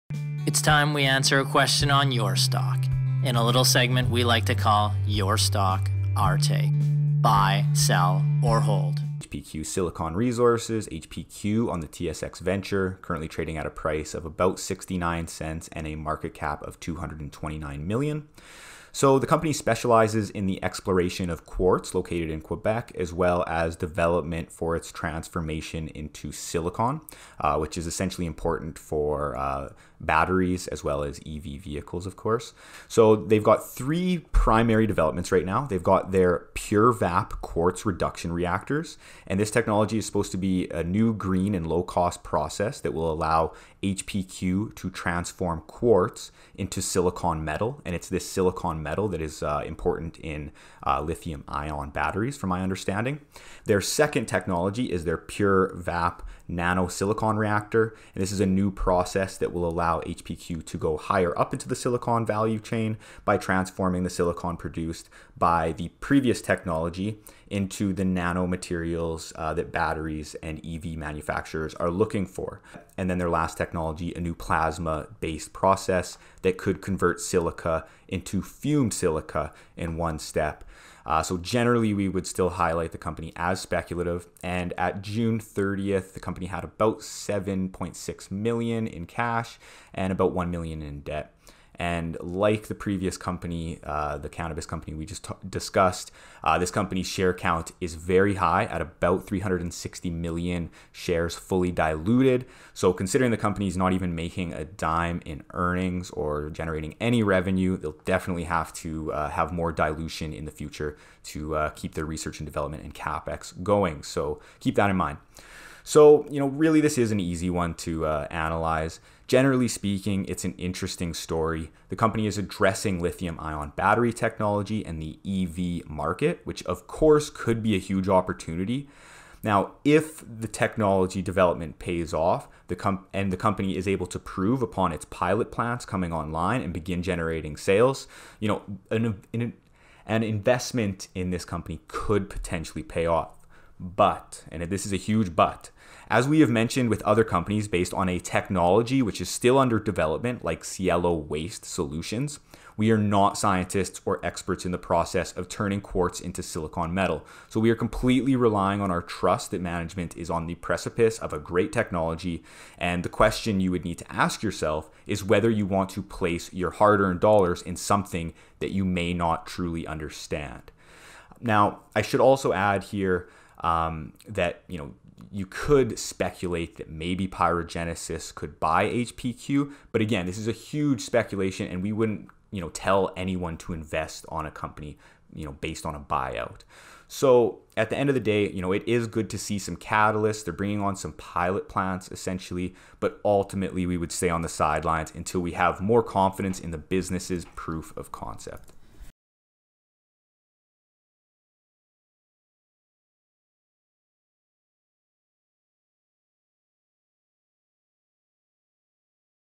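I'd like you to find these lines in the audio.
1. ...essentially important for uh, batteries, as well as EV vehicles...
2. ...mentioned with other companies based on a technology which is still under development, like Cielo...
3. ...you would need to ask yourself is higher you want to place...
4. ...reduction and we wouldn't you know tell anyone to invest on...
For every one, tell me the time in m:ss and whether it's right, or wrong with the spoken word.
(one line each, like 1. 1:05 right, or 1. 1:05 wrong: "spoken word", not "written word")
1. 0:27 right
2. 2:26 right
3. 2:43 wrong: "whether", not "higher"
4. 3:01 wrong: "speculation", not "reduction".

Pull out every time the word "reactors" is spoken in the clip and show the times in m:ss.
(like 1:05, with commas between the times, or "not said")
0:38, 0:57.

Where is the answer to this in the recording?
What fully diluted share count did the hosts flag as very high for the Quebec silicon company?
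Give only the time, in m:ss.
1:39.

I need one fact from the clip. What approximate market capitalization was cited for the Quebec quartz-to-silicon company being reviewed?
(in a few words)
229 million.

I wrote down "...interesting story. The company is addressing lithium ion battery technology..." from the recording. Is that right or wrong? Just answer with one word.
right.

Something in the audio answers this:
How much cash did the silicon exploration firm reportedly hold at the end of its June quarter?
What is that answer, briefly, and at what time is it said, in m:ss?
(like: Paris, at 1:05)
7.6 million, at 1:26.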